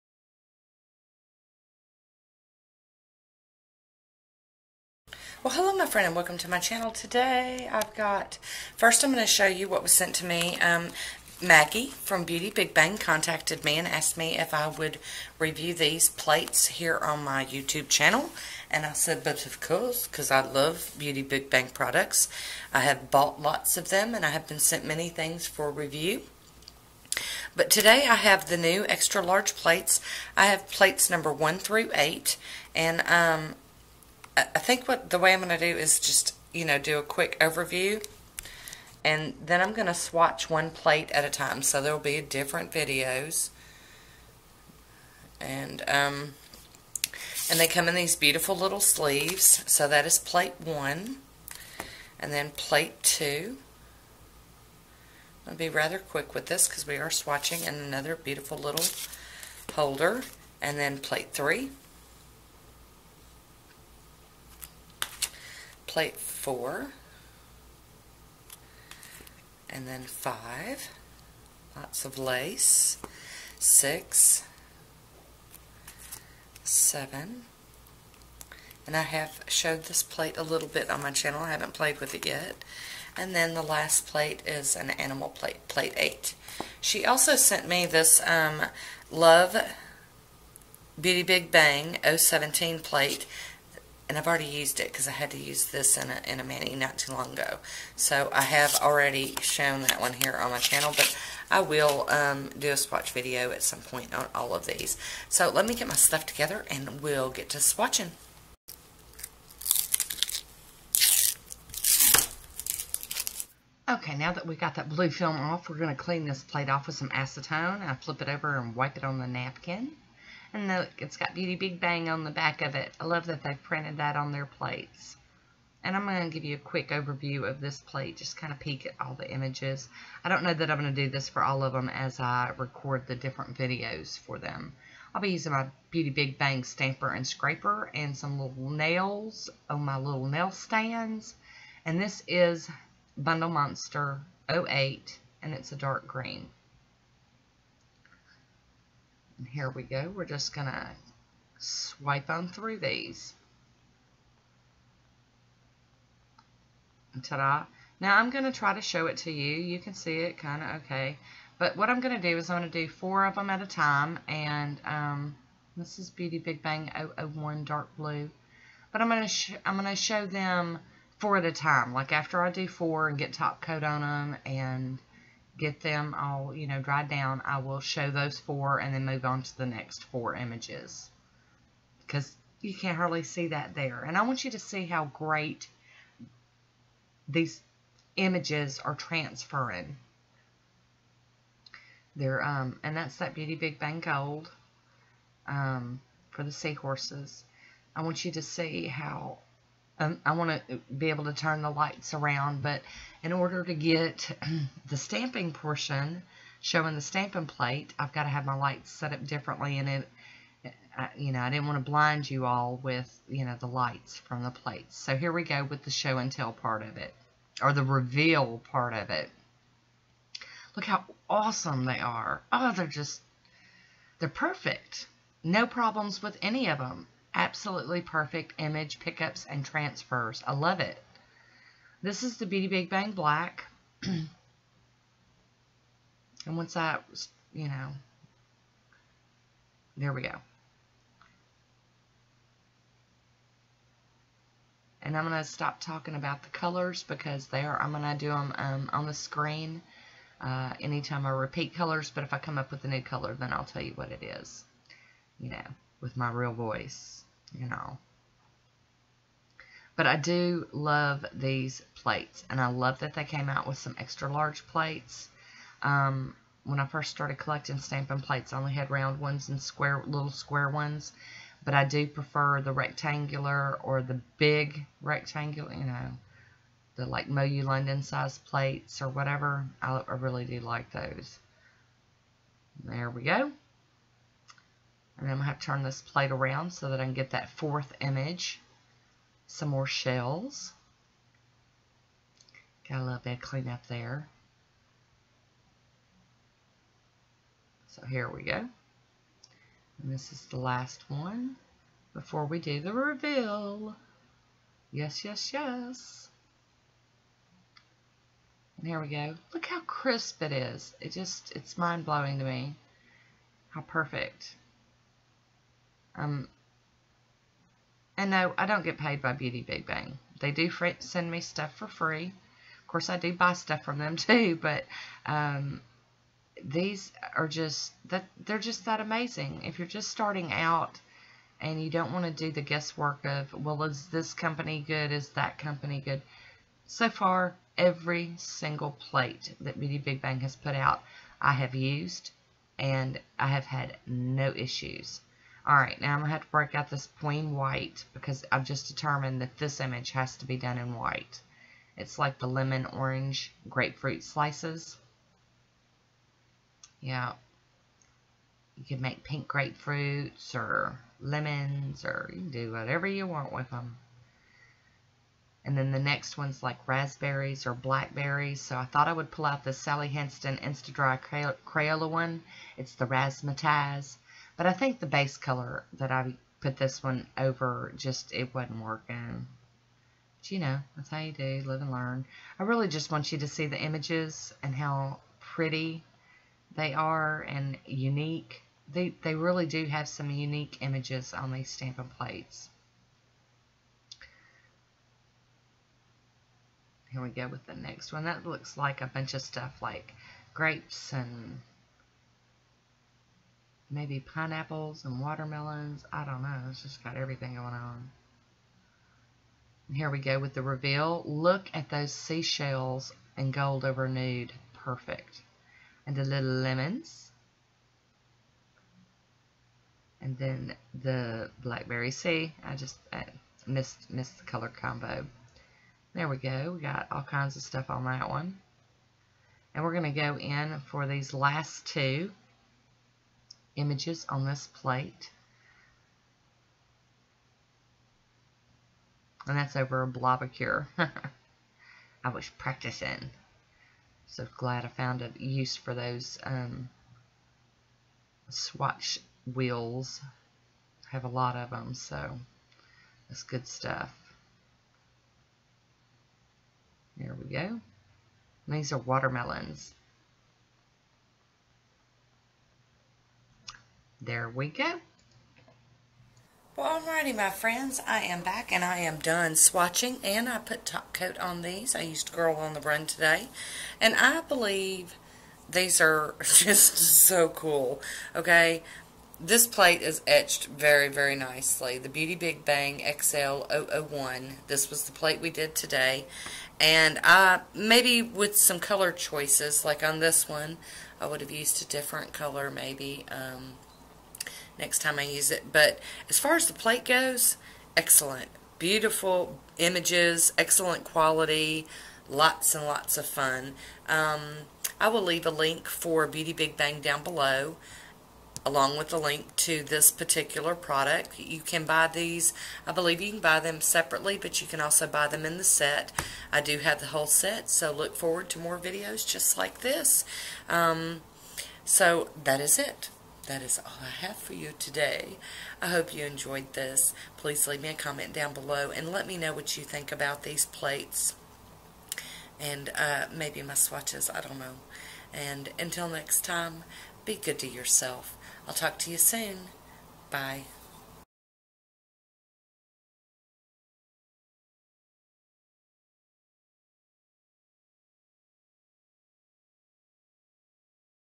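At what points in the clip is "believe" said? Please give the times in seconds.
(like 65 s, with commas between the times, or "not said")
474 s, 512 s.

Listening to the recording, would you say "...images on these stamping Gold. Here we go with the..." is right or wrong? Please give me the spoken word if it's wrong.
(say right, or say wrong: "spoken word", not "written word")
wrong: "Plates", not "Gold".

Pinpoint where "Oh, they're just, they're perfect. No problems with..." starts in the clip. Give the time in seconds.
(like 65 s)
222 s.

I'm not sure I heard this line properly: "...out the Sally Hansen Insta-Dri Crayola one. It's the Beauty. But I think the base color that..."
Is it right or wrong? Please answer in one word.
wrong.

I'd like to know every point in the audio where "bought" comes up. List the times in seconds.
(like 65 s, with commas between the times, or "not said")
23 s.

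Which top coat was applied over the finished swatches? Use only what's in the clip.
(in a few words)
Girl on the Run.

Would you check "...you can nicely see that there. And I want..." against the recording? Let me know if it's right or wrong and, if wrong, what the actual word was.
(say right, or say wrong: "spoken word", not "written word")
wrong: "hardly", not "nicely".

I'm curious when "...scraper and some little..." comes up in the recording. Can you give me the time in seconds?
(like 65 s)
137 s.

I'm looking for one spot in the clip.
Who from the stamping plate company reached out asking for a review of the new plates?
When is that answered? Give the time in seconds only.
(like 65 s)
11 s.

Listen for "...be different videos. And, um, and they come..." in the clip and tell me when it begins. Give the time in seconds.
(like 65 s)
41 s.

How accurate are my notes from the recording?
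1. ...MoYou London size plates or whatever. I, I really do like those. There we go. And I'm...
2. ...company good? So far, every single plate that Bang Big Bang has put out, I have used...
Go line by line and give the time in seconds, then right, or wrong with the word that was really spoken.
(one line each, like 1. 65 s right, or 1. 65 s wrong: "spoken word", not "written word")
1. 277 s right
2. 335 s wrong: "Beauty", not "Bang".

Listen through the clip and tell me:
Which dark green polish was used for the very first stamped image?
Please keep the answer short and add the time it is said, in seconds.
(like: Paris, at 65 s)
Bundle Monster 08, at 143 s.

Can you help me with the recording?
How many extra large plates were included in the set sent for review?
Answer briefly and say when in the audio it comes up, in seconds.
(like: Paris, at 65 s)
8, at 30 s.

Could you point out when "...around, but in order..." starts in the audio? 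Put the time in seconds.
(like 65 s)
202 s.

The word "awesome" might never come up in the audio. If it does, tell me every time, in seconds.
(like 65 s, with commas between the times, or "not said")
221 s.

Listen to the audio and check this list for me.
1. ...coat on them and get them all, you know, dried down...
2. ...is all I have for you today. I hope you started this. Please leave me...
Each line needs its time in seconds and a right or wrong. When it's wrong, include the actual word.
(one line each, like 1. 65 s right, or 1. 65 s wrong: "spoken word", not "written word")
1. 173 s right
2. 523 s wrong: "enjoyed", not "started".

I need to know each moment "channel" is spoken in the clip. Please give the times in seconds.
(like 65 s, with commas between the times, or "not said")
6 s, 17 s, 81 s, 100 s.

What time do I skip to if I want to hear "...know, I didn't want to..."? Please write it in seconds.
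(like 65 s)
211 s.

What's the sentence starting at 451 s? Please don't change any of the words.
I have a lot of them, so that's good stuff.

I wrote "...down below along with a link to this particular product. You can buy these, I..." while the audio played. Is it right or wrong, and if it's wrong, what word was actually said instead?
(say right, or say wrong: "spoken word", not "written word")
right.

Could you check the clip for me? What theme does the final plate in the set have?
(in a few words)
animal.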